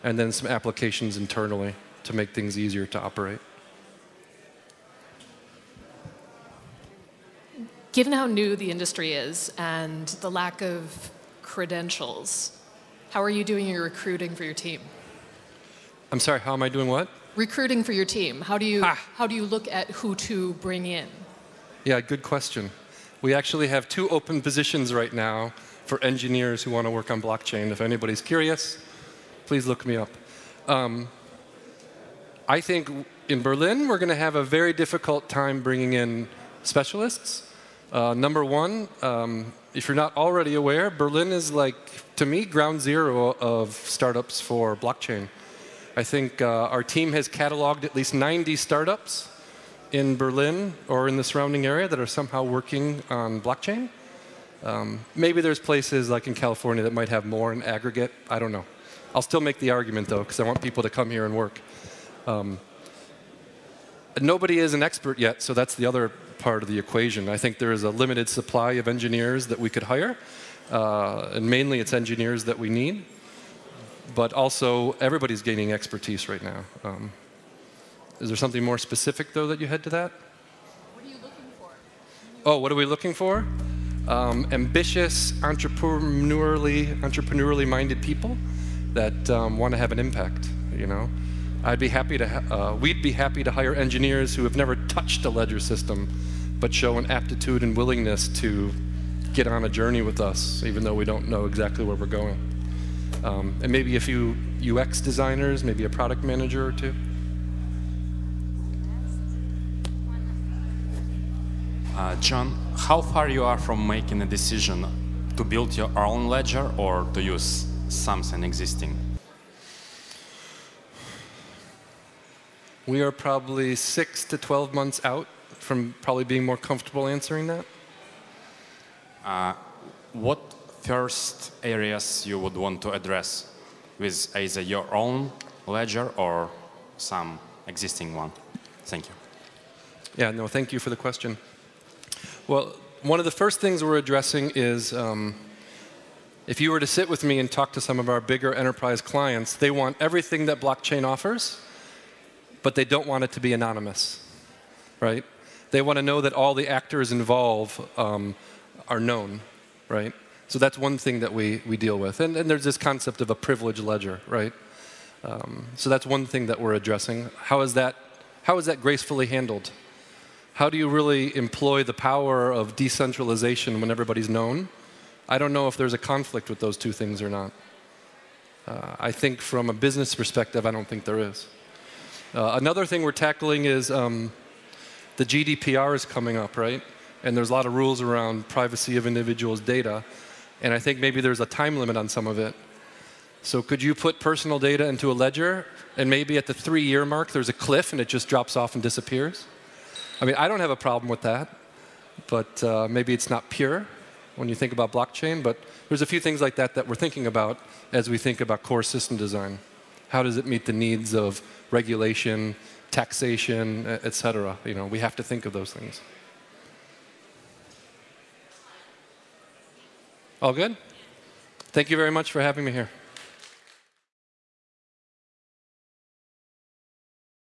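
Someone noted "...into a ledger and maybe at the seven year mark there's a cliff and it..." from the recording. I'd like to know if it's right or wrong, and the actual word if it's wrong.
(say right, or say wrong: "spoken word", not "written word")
wrong: "three", not "seven".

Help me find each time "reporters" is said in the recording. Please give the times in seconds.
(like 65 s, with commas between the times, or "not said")
not said.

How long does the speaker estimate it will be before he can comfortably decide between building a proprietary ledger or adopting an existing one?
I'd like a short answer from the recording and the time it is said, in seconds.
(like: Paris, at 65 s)
6 to 12 months, at 123 s.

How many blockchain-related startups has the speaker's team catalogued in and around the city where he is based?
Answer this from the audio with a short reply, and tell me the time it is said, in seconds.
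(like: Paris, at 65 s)
90, at 48 s.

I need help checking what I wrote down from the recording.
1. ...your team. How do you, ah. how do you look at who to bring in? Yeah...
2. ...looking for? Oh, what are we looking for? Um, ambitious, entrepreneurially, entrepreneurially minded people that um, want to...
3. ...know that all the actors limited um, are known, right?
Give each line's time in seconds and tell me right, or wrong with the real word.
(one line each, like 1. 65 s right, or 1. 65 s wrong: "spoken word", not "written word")
1. 17 s right
2. 81 s right
3. 156 s wrong: "involved", not "limited".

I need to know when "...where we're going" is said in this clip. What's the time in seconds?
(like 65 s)
101 s.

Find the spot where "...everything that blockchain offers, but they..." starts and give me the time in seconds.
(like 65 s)
149 s.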